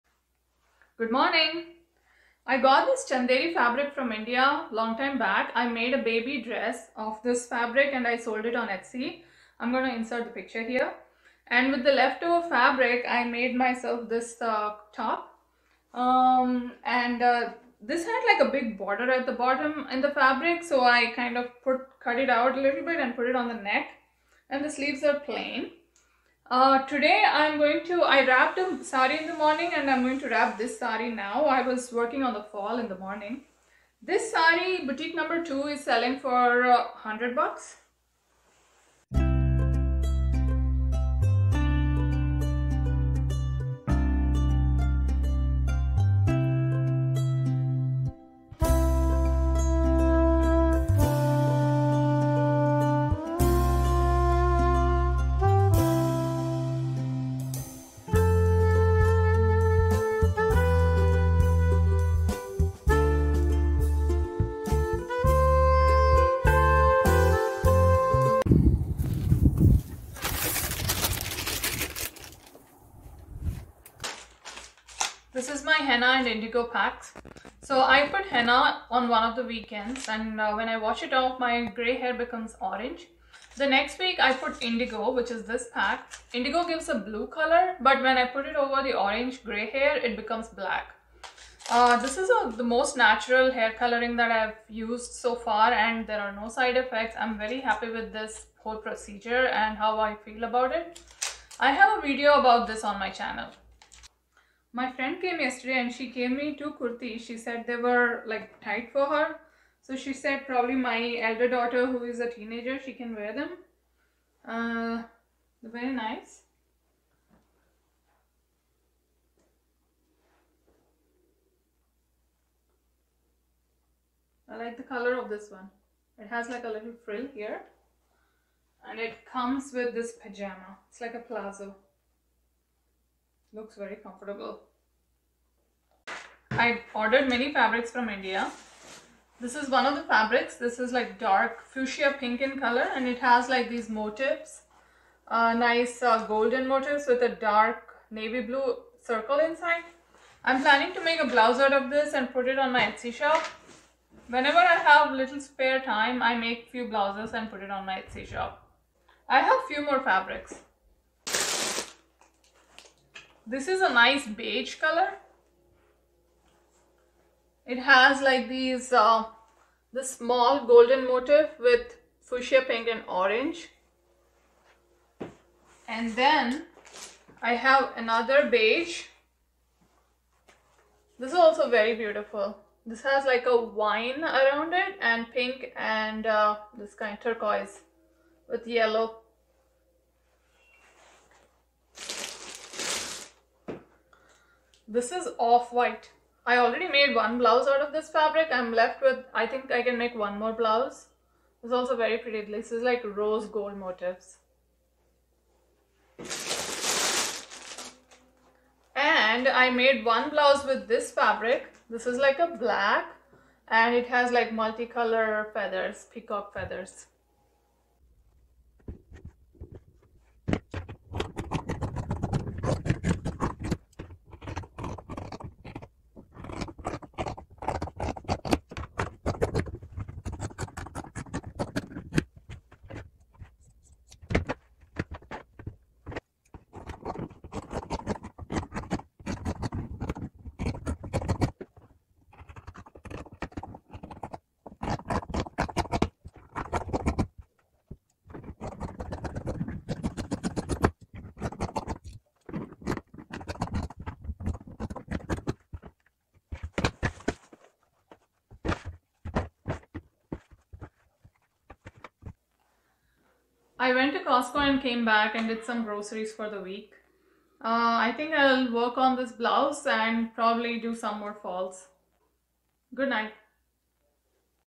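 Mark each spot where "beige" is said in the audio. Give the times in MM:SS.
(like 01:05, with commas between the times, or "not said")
02:44, 02:58.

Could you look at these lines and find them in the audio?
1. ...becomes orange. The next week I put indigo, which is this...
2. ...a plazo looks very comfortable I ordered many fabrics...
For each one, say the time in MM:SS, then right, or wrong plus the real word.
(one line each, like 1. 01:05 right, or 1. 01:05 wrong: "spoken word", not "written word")
1. 01:22 right
2. 02:11 right.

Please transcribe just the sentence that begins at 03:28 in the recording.
And I made one blouse with this fabric.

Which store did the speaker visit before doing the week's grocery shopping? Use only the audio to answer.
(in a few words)
Costco.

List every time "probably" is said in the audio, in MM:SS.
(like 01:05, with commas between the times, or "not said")
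01:50, 04:30.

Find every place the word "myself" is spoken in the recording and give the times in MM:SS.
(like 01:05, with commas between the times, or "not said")
00:13.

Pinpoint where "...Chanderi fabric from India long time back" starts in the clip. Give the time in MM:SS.
00:03.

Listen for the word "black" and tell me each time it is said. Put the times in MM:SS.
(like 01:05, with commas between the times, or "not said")
01:30, 03:32.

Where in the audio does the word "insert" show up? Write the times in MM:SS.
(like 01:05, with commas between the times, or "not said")
00:09.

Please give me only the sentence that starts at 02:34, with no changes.
Whenever I have little spare time, I make few blouses and put it on my Etsy shop.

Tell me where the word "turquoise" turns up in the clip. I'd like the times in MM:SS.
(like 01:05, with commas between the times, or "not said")
03:07.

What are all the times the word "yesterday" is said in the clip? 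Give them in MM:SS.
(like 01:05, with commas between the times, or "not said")
01:45.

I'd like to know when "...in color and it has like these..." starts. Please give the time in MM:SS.
02:22.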